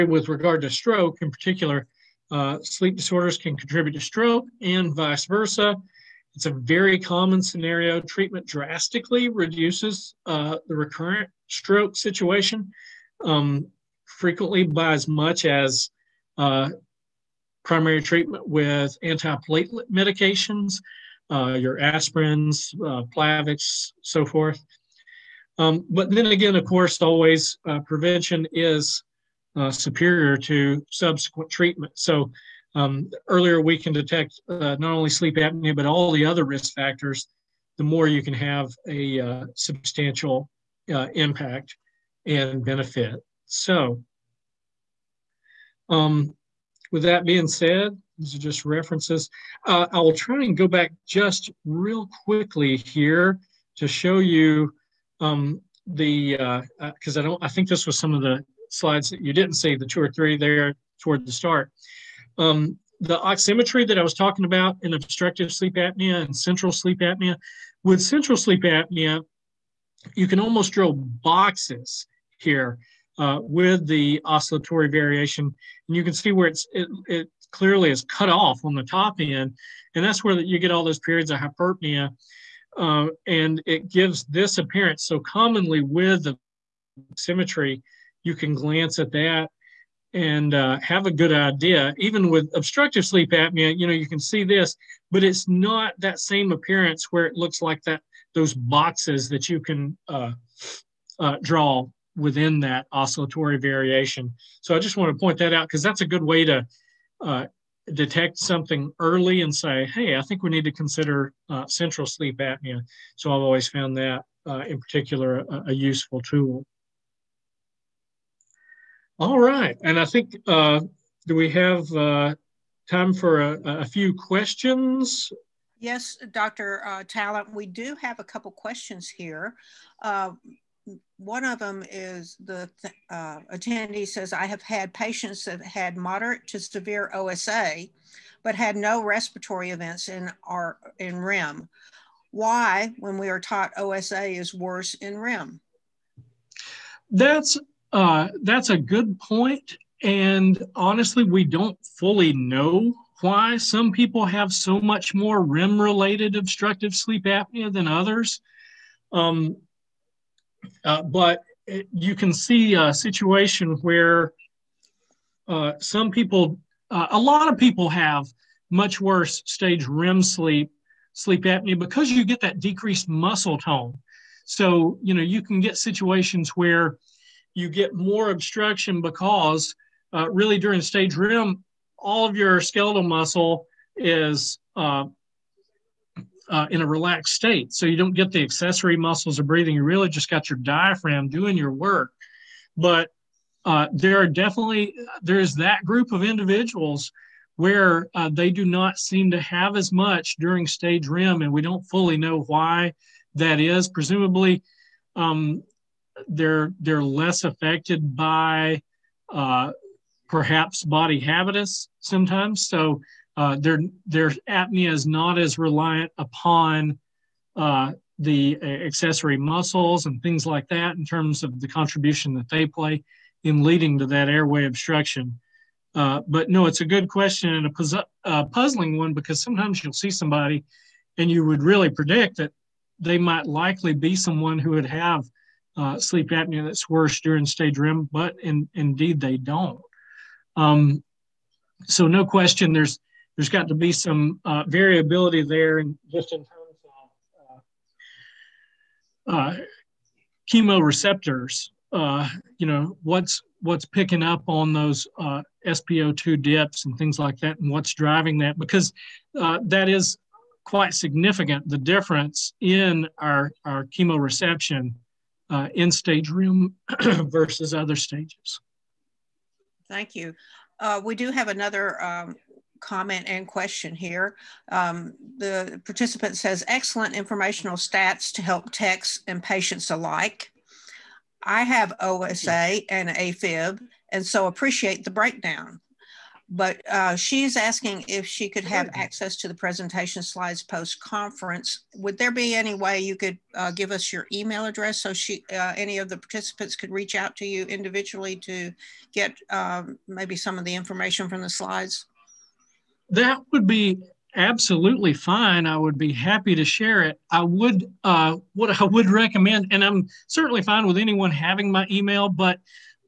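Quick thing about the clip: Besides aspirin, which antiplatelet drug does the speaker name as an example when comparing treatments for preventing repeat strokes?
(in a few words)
Plavix.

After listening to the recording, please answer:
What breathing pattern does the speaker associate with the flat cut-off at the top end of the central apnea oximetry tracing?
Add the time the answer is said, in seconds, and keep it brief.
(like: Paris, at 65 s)
Hyperpnea, at 81 s.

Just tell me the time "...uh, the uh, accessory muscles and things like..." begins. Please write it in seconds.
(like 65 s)
217 s.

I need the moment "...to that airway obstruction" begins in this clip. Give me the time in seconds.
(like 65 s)
223 s.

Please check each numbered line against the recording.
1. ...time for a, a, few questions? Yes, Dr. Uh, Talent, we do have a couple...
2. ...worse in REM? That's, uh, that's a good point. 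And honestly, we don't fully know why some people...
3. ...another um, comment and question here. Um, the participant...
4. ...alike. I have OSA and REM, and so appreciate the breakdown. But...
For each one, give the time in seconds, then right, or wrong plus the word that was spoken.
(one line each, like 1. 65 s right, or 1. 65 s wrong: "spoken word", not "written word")
1. 122 s right
2. 144 s right
3. 271 s right
4. 279 s wrong: "AFib", not "REM".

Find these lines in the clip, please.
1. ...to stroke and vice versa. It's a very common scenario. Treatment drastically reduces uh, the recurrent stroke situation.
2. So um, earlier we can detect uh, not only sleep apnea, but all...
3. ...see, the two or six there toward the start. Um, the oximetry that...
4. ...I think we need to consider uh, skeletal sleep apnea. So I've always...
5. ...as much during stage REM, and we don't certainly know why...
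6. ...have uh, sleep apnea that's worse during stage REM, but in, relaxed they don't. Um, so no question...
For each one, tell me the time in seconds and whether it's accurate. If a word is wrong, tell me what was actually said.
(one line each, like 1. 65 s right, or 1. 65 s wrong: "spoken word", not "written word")
1. 3 s right
2. 31 s right
3. 59 s wrong: "three", not "six"
4. 110 s wrong: "central", not "skeletal"
5. 199 s wrong: "fully", not "certainly"
6. 234 s wrong: "indeed", not "relaxed".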